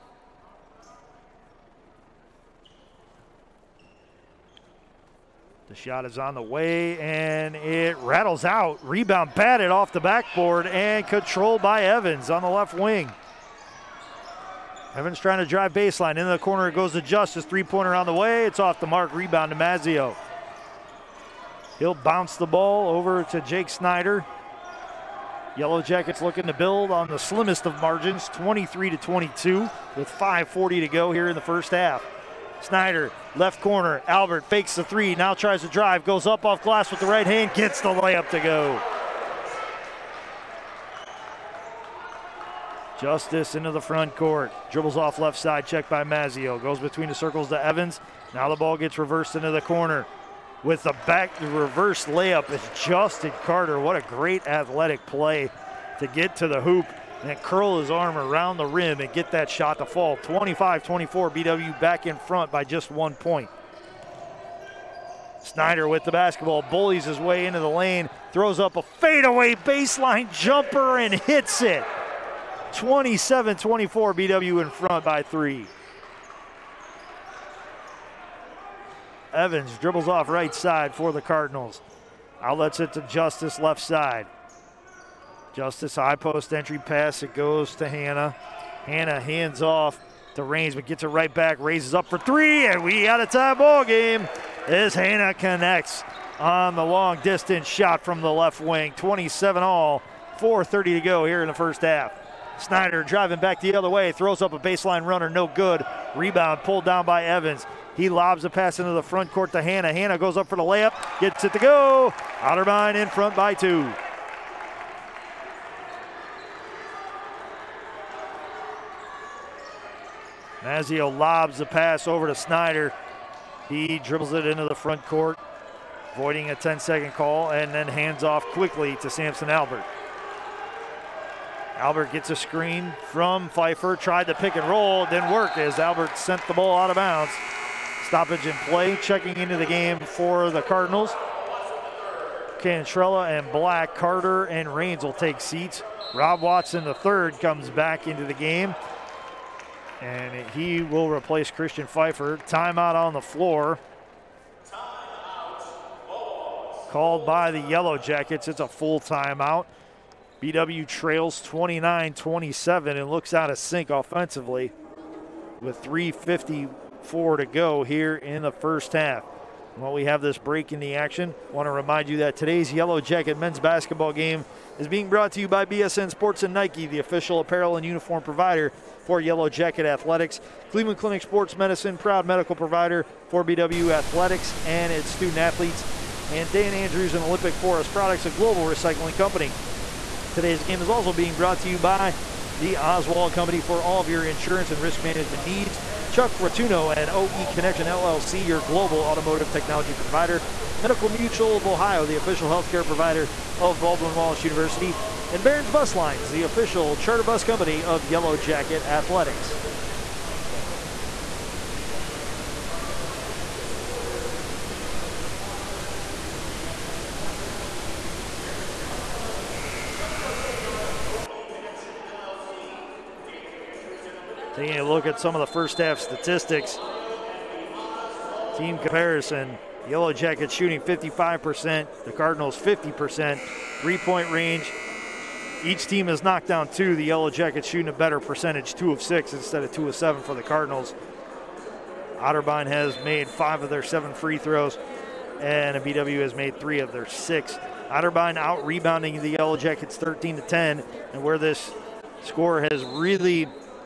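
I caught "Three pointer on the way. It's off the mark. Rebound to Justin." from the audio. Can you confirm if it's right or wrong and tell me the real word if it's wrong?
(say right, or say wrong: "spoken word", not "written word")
wrong: "Mazio", not "Justin".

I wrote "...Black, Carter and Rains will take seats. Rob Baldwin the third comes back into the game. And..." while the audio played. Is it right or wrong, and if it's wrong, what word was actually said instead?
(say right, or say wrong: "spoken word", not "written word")
wrong: "Watson", not "Baldwin".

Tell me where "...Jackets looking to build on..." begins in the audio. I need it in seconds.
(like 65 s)
25 s.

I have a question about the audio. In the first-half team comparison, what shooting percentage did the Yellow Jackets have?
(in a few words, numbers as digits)
55%.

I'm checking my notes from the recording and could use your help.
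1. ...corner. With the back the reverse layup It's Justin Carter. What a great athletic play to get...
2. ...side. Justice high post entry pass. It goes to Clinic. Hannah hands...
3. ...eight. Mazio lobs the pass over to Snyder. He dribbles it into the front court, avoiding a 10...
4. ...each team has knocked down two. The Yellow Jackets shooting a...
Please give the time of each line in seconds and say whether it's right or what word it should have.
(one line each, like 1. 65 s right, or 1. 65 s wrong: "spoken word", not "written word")
1. 49 s right
2. 83 s wrong: "Hannah", not "Clinic"
3. 113 s wrong: "two", not "eight"
4. 235 s right.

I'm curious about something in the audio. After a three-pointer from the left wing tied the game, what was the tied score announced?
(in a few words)
27 all.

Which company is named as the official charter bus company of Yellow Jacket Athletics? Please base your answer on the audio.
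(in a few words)
Barons Bus Lines.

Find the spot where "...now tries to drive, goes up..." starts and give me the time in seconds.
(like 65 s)
35 s.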